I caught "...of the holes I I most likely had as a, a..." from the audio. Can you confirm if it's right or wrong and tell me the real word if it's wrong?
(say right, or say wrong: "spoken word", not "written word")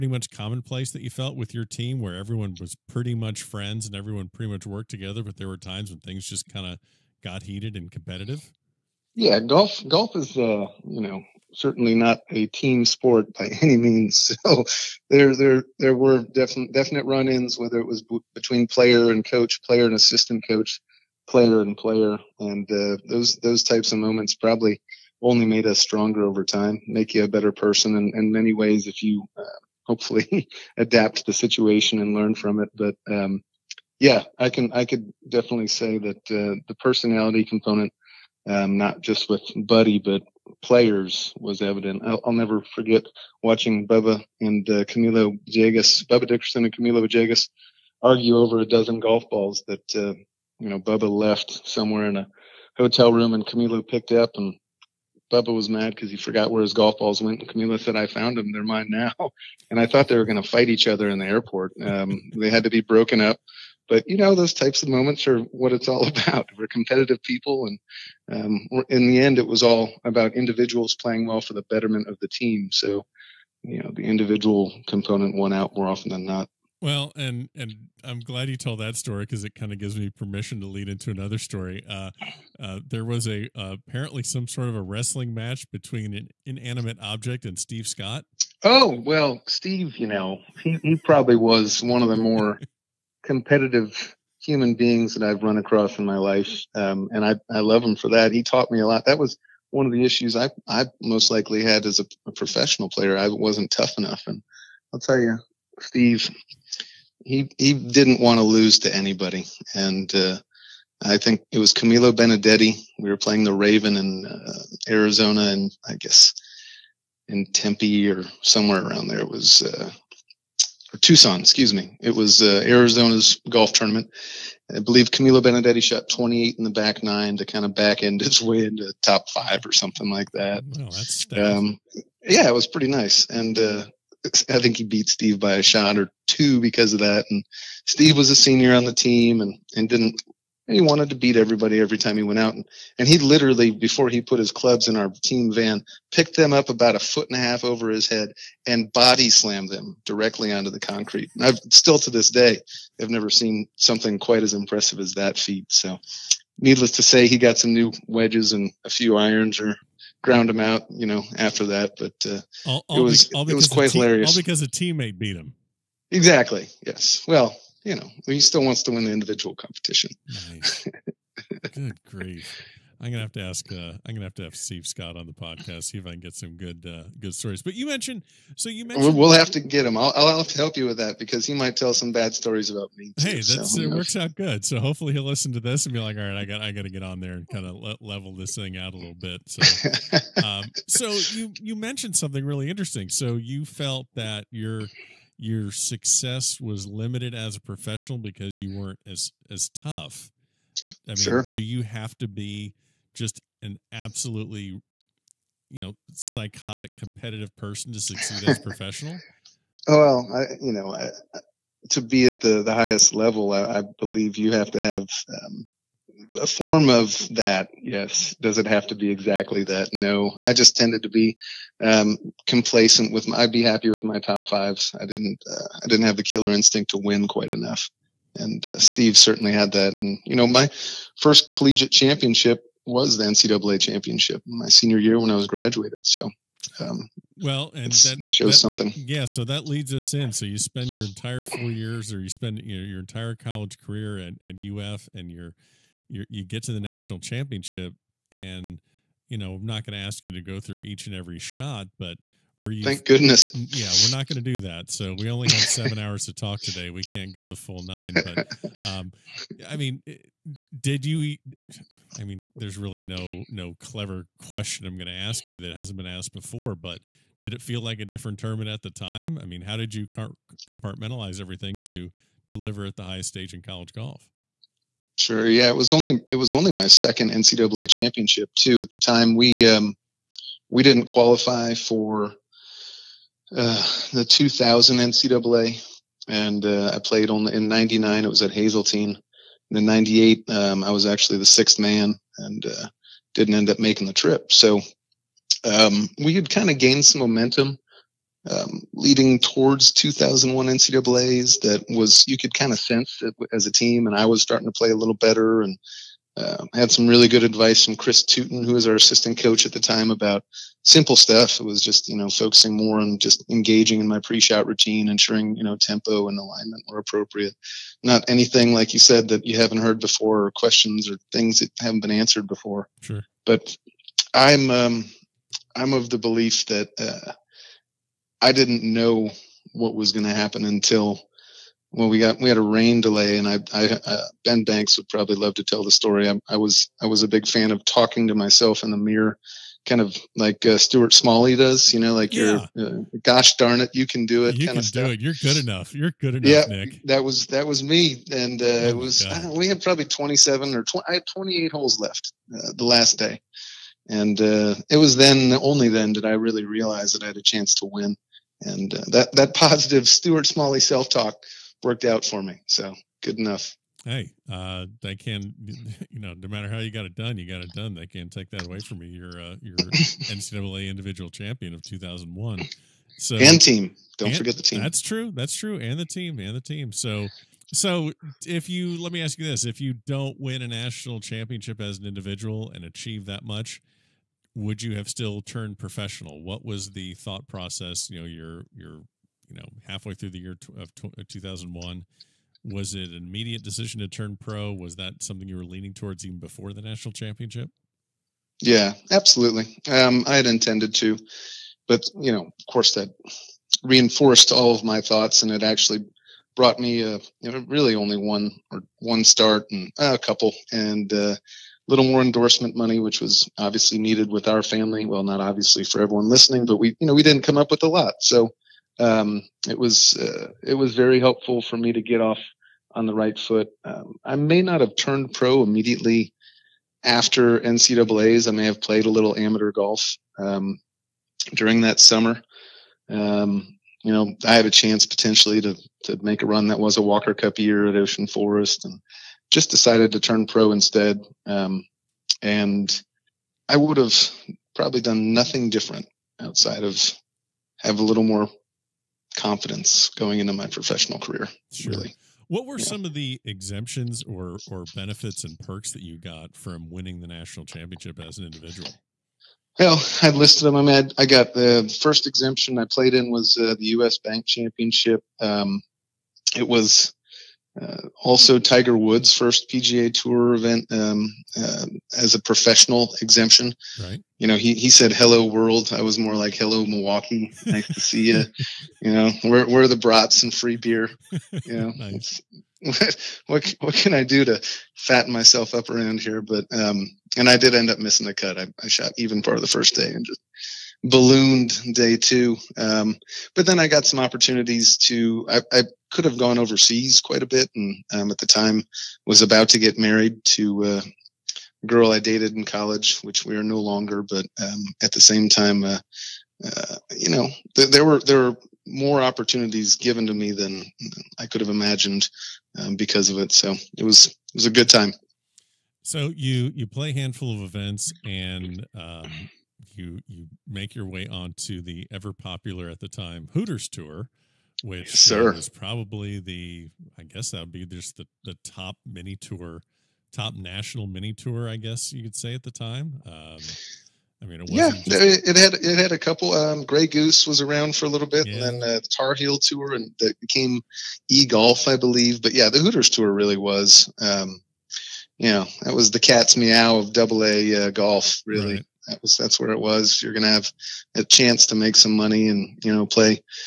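wrong: "issues", not "holes".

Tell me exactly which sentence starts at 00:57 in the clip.
And Camilo said, I found them.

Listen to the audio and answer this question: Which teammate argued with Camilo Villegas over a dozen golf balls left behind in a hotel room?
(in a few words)
Bubba Dickerson.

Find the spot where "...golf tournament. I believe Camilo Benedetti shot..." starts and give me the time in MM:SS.
02:03.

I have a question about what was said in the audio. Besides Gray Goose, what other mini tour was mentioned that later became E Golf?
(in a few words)
Tar Heel tour.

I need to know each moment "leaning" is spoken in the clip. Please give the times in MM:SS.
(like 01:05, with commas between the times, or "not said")
06:35.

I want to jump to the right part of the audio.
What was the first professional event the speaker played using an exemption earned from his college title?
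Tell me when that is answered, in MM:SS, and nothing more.
07:43.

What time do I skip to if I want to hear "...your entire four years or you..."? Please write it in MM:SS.
04:00.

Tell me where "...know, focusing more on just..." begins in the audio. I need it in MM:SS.
05:12.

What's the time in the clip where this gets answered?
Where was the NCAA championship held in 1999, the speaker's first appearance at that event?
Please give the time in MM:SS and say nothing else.
04:48.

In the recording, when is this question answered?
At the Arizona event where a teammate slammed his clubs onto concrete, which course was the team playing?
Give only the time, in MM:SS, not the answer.
01:53.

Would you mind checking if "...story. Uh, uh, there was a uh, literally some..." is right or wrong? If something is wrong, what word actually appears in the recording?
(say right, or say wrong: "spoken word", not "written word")
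wrong: "apparently", not "literally".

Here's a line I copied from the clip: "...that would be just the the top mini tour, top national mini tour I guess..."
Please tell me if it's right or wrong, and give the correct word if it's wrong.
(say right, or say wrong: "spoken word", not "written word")
right.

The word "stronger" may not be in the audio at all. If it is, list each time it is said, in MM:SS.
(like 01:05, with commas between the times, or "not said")
00:25.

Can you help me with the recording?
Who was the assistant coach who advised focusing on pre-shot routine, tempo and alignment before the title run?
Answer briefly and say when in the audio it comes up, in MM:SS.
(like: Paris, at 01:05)
Chris Tooten, at 05:07.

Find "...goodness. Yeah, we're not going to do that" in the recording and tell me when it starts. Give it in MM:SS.
04:13.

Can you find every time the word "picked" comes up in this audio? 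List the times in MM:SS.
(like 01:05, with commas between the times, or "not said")
00:53, 02:26.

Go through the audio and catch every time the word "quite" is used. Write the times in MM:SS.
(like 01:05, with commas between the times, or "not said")
02:34, 02:43, 03:47, 08:17.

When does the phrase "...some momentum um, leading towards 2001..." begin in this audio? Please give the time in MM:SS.
04:57.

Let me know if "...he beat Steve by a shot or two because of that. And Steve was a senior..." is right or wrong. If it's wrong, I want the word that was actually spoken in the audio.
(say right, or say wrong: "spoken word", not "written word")
right.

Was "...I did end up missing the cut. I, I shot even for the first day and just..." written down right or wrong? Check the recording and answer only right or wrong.
right.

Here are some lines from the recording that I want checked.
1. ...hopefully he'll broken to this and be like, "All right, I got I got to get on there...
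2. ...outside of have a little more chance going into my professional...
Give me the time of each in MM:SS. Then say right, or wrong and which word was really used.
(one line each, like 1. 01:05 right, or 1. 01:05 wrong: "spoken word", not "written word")
1. 03:04 wrong: "listen", not "broken"
2. 07:26 wrong: "confidence", not "chance".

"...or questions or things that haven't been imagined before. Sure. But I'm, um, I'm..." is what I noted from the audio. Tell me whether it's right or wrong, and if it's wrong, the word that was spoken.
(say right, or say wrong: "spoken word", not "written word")
wrong: "answered", not "imagined".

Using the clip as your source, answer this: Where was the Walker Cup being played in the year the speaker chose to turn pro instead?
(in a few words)
Ocean Forest.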